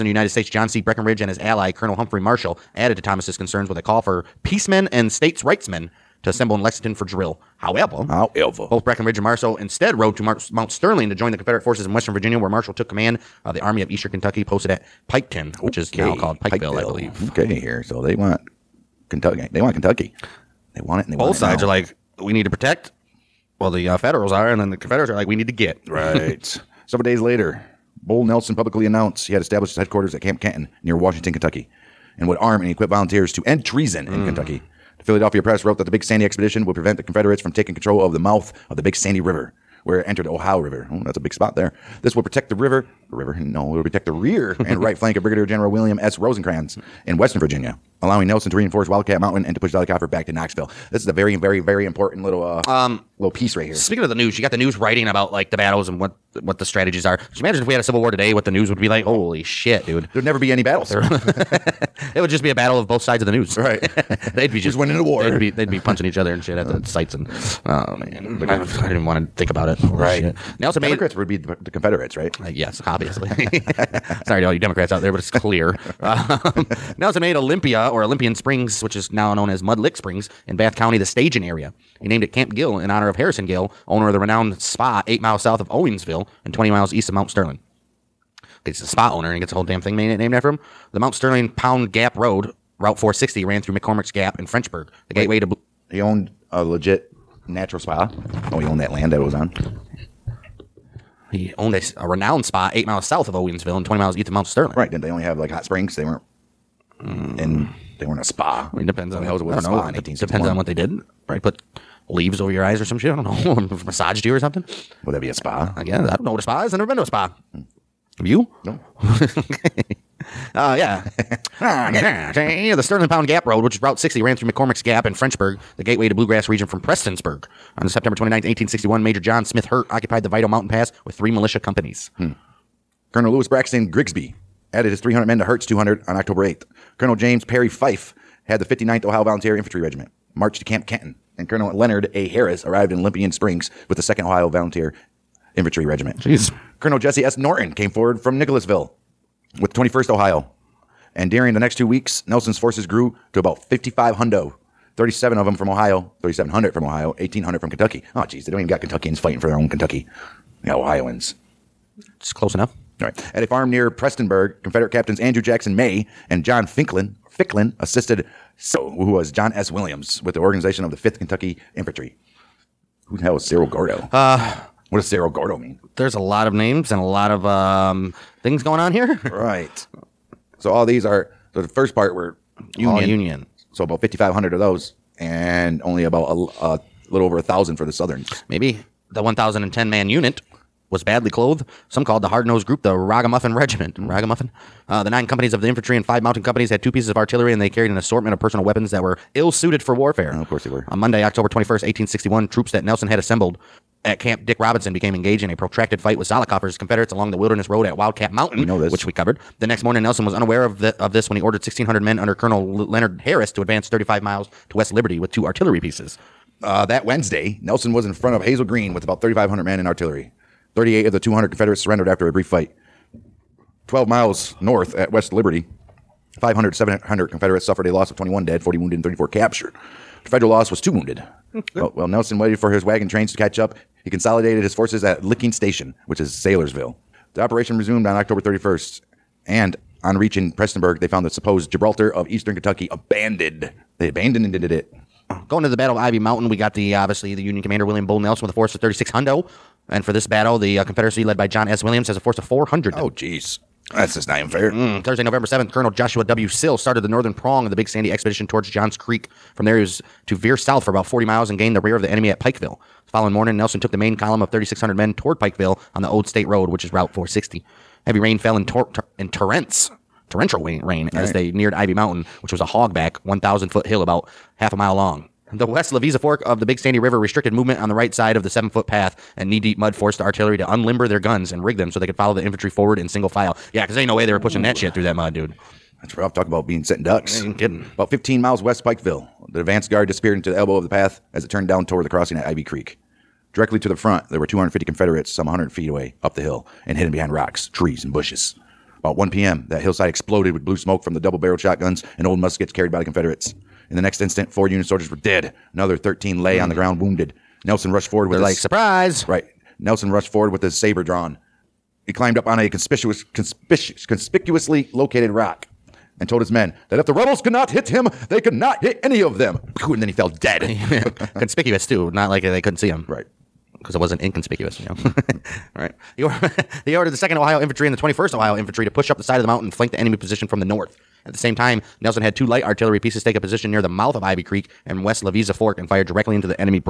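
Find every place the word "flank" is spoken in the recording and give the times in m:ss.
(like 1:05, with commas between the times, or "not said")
0:44, 5:29.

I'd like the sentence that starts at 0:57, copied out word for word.
Just imagine if we had a civil war today, what the news would be like.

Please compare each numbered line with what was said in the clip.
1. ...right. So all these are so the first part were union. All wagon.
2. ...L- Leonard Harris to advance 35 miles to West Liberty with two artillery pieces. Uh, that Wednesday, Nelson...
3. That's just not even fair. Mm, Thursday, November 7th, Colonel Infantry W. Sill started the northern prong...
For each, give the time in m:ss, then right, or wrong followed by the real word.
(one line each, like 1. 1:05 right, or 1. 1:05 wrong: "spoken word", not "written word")
1. 2:59 wrong: "union", not "wagon"
2. 3:32 right
3. 4:13 wrong: "Joshua", not "Infantry".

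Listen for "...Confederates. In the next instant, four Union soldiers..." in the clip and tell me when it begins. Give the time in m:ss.
5:03.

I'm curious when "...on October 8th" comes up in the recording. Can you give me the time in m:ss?
2:16.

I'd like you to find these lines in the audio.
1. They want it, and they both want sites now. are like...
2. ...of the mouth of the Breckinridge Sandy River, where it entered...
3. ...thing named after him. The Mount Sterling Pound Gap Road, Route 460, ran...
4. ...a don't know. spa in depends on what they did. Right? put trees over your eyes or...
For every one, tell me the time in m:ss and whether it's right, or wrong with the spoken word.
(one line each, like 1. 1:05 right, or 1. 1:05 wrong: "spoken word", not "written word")
1. 0:20 wrong: "sides", not "sites"
2. 0:38 wrong: "Big", not "Breckinridge"
3. 1:29 right
4. 1:49 wrong: "leaves", not "trees".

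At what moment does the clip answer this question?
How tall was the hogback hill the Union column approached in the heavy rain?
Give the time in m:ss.
4:33.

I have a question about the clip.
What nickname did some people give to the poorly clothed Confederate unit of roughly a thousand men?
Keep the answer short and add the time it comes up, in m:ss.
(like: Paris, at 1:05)
Ragamuffin Regiment, at 3:12.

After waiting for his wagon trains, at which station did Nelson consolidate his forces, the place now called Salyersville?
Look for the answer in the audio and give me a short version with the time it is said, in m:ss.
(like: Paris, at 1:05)
Licking Station, at 3:55.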